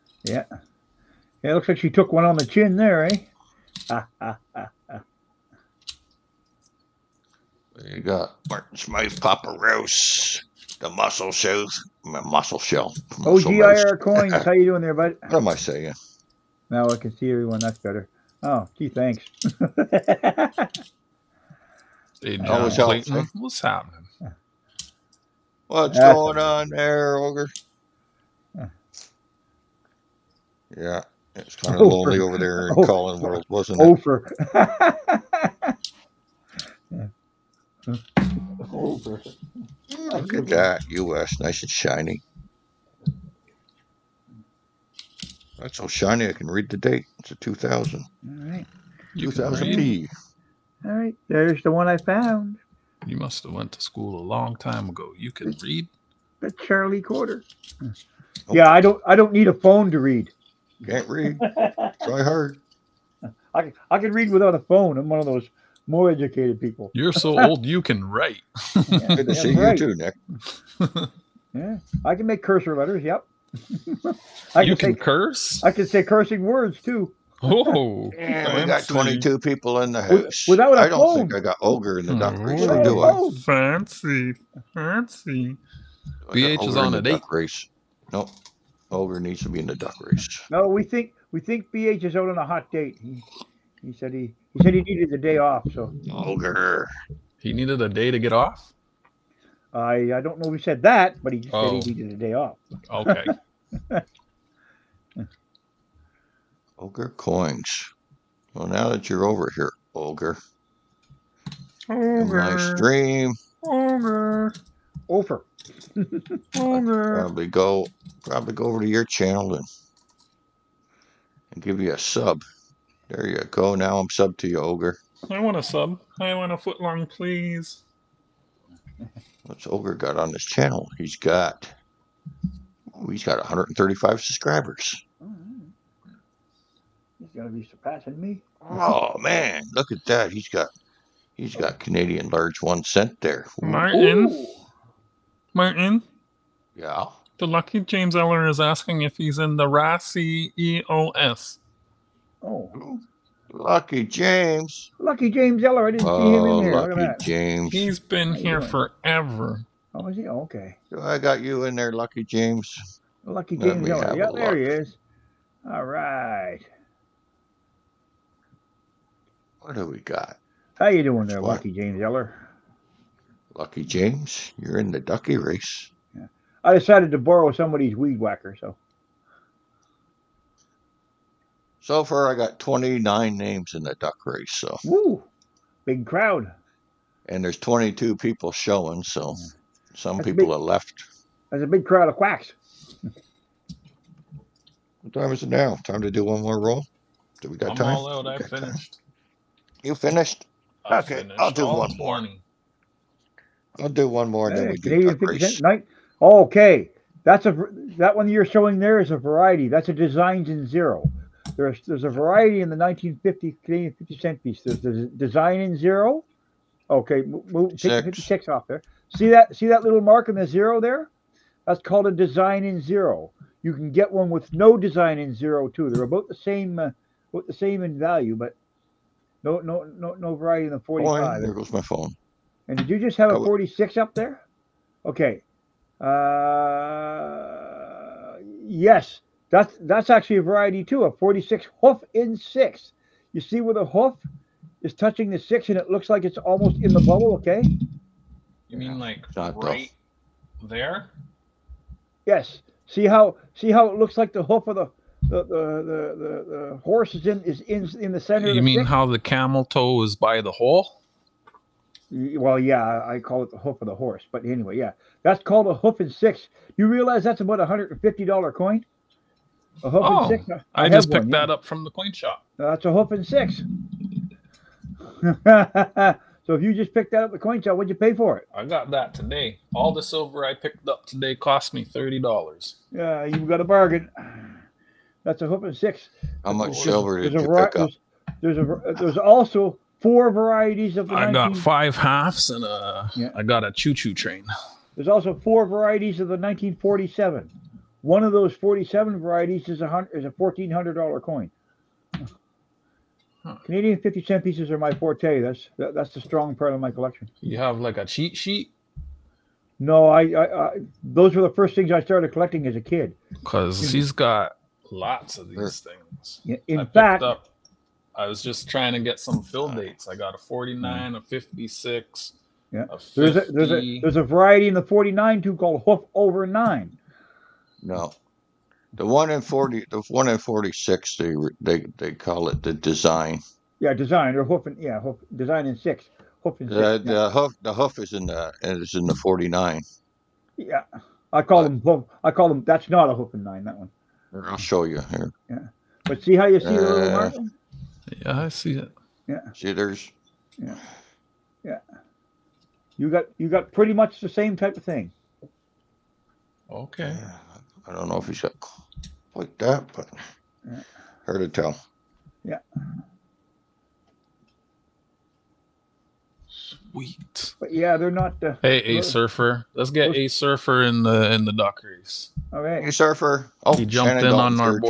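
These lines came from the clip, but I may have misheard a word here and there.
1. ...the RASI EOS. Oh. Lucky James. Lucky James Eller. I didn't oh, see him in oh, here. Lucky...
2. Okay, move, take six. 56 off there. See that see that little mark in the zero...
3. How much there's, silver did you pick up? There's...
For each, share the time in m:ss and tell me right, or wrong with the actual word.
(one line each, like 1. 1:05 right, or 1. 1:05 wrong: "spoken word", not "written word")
1. 2:29 right
2. 3:36 right
3. 4:46 right.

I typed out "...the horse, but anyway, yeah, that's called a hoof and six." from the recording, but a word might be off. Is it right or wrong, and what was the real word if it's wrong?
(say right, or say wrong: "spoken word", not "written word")
right.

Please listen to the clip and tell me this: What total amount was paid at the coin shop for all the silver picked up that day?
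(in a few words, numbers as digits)
$30.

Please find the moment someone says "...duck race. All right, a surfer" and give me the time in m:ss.
6:11.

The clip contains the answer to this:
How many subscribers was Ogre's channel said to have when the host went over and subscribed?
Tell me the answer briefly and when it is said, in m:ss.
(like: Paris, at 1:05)
135, at 2:13.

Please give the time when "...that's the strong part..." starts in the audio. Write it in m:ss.
5:05.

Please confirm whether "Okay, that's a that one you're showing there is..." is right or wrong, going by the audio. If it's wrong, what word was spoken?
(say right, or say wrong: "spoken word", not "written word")
right.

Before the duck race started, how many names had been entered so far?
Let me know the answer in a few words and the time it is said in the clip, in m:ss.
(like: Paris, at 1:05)
29, at 3:02.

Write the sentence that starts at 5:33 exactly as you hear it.
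Yeah, design or hoof and yeah, hoof, design in six, hoof and six.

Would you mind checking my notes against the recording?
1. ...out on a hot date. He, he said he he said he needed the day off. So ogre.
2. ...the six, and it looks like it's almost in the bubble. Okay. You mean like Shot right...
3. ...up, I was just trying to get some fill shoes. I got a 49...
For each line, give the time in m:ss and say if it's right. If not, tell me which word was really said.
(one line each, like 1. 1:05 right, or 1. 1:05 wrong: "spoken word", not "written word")
1. 1:32 right
2. 4:05 right
3. 5:17 wrong: "dates", not "shoes".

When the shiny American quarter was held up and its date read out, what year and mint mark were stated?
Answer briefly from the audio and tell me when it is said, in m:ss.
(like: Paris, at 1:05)
2000P, at 0:49.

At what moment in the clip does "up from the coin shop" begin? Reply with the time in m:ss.
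4:31.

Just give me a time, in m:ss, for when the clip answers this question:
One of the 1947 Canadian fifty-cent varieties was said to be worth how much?
5:00.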